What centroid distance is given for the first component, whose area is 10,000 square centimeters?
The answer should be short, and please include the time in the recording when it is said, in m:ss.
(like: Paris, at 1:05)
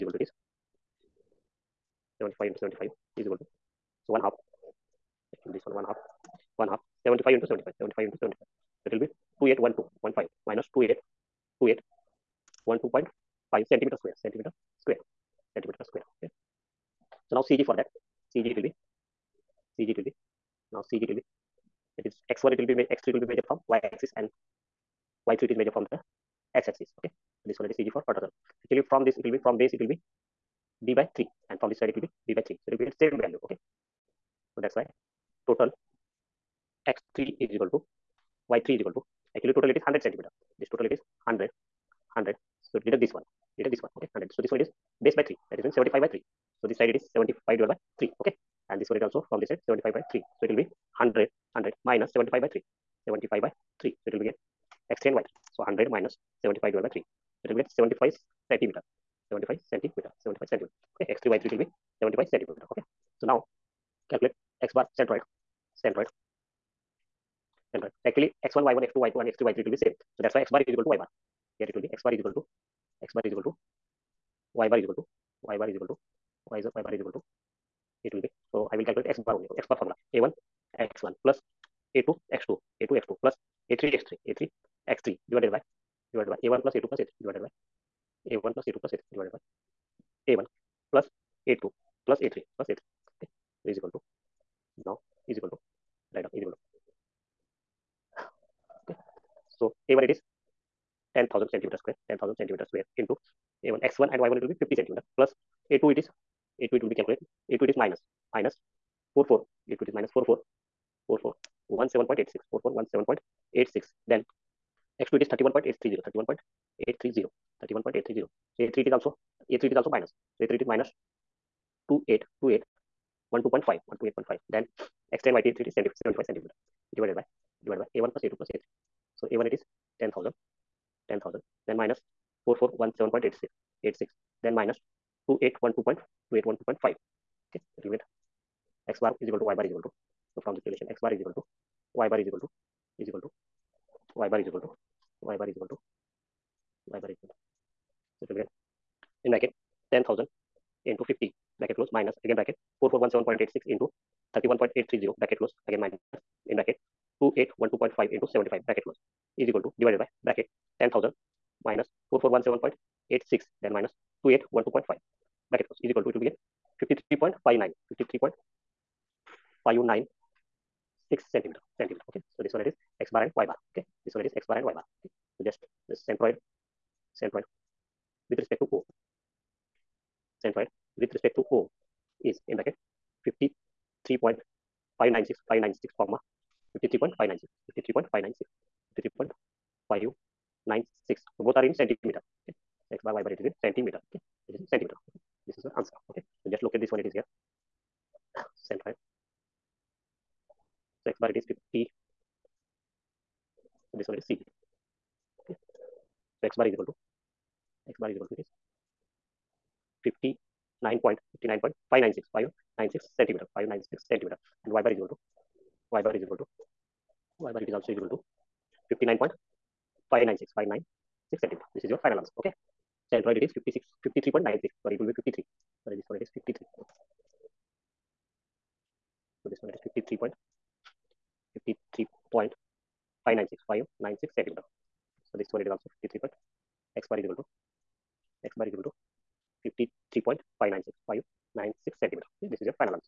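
50 centimeter, at 1:44.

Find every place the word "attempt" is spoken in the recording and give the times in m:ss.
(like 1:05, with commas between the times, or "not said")
not said.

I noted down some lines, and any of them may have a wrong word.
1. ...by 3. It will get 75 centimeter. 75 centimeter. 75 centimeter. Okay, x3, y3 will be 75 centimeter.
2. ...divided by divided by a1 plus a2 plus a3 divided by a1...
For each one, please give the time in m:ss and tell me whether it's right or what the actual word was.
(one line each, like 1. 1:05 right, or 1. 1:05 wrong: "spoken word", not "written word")
1. 0:56 right
2. 1:25 right.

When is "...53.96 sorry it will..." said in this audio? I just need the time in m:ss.
3:44.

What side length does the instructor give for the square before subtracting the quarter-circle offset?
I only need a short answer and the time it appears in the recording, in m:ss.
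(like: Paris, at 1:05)
100 centimeter, at 0:39.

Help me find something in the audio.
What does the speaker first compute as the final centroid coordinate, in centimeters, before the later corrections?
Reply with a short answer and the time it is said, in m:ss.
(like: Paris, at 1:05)
53.596, at 2:47.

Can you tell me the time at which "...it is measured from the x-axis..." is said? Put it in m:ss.
0:25.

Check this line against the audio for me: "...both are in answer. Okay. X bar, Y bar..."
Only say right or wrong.
wrong.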